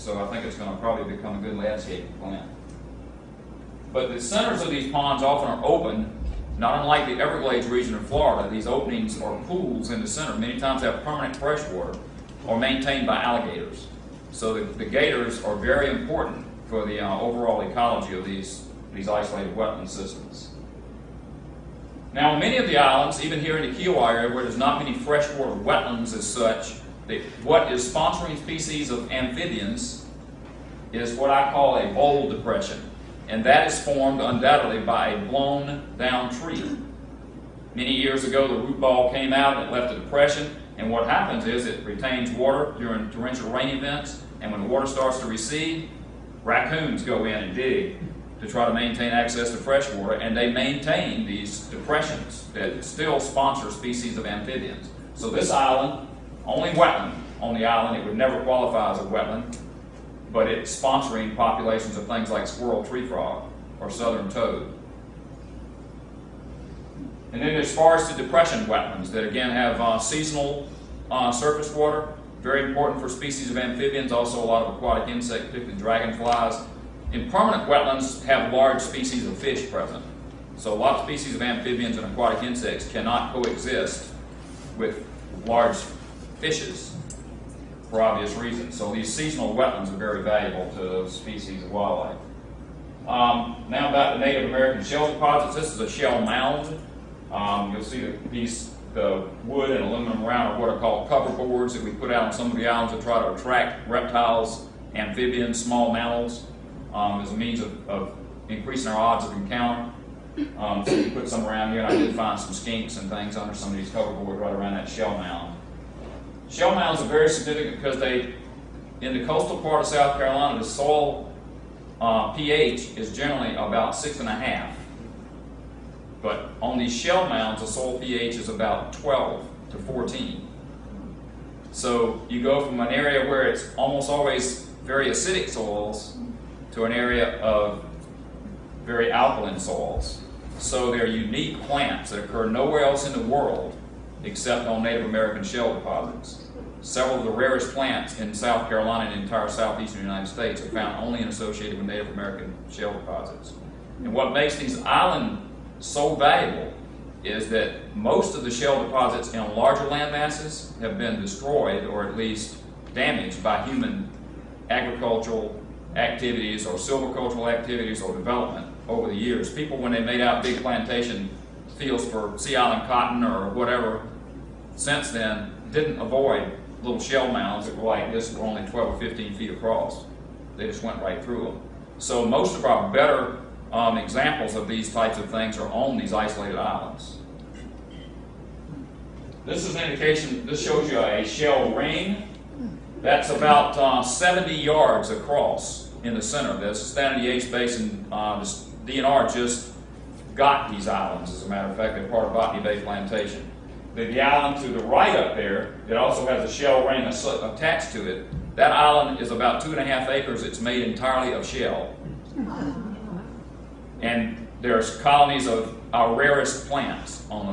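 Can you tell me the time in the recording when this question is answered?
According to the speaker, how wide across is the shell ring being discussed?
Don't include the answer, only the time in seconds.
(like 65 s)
194 s.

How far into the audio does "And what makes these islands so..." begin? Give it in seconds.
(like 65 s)
153 s.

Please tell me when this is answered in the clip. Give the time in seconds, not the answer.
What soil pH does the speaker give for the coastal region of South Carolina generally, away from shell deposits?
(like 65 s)
123 s.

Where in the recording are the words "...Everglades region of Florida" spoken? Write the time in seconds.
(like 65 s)
7 s.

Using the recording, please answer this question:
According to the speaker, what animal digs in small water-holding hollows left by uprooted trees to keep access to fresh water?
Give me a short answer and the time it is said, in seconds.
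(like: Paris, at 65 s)
Raccoons, at 46 s.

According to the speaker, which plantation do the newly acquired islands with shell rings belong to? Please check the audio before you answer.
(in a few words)
Botany Bay Plantation.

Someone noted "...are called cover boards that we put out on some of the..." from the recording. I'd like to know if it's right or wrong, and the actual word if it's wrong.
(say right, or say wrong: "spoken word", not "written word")
right.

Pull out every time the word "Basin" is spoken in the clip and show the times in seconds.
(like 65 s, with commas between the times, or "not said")
197 s.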